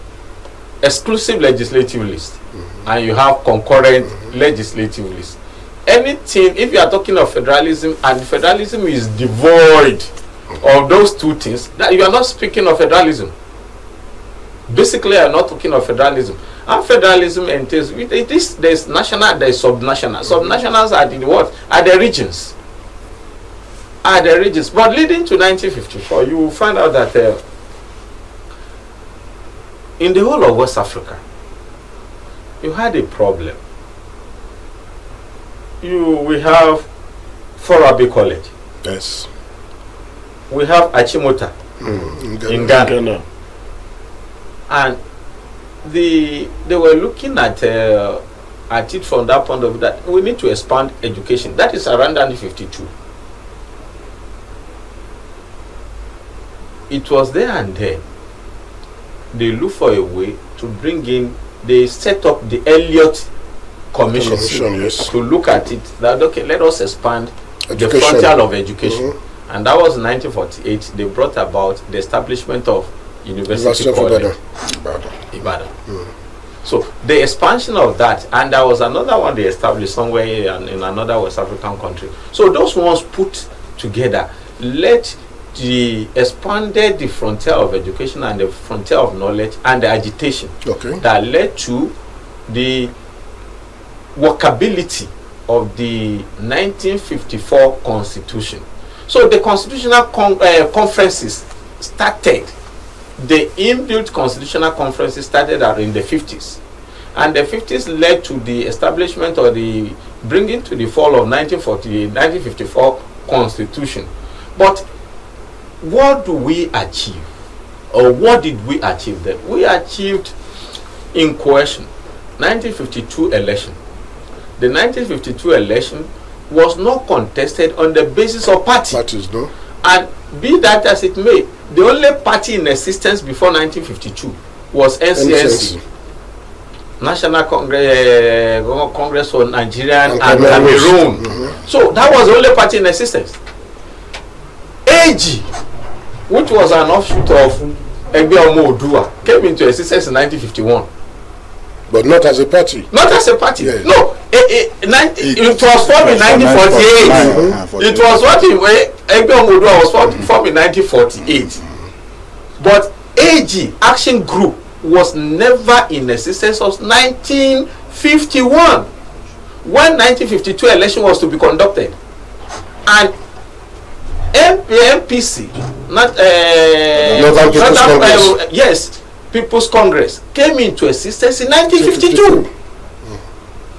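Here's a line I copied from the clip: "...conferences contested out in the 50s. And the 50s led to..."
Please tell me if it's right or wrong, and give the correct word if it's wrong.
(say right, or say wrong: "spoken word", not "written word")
wrong: "started", not "contested".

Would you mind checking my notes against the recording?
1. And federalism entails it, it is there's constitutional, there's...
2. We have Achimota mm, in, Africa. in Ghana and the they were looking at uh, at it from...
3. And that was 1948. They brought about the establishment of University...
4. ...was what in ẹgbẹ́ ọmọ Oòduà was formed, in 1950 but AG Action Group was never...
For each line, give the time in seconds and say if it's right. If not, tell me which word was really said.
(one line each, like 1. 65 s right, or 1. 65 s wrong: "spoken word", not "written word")
1. 16 s wrong: "national", not "constitutional"
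2. 40 s wrong: "Ghana", not "Africa"
3. 69 s right
4. 157 s wrong: "1948", not "1950".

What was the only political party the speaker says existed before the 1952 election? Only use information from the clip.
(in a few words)
NCNC.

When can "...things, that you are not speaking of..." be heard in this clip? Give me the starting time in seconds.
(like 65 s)
11 s.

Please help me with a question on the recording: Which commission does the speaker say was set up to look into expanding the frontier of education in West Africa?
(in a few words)
Elliott Commission.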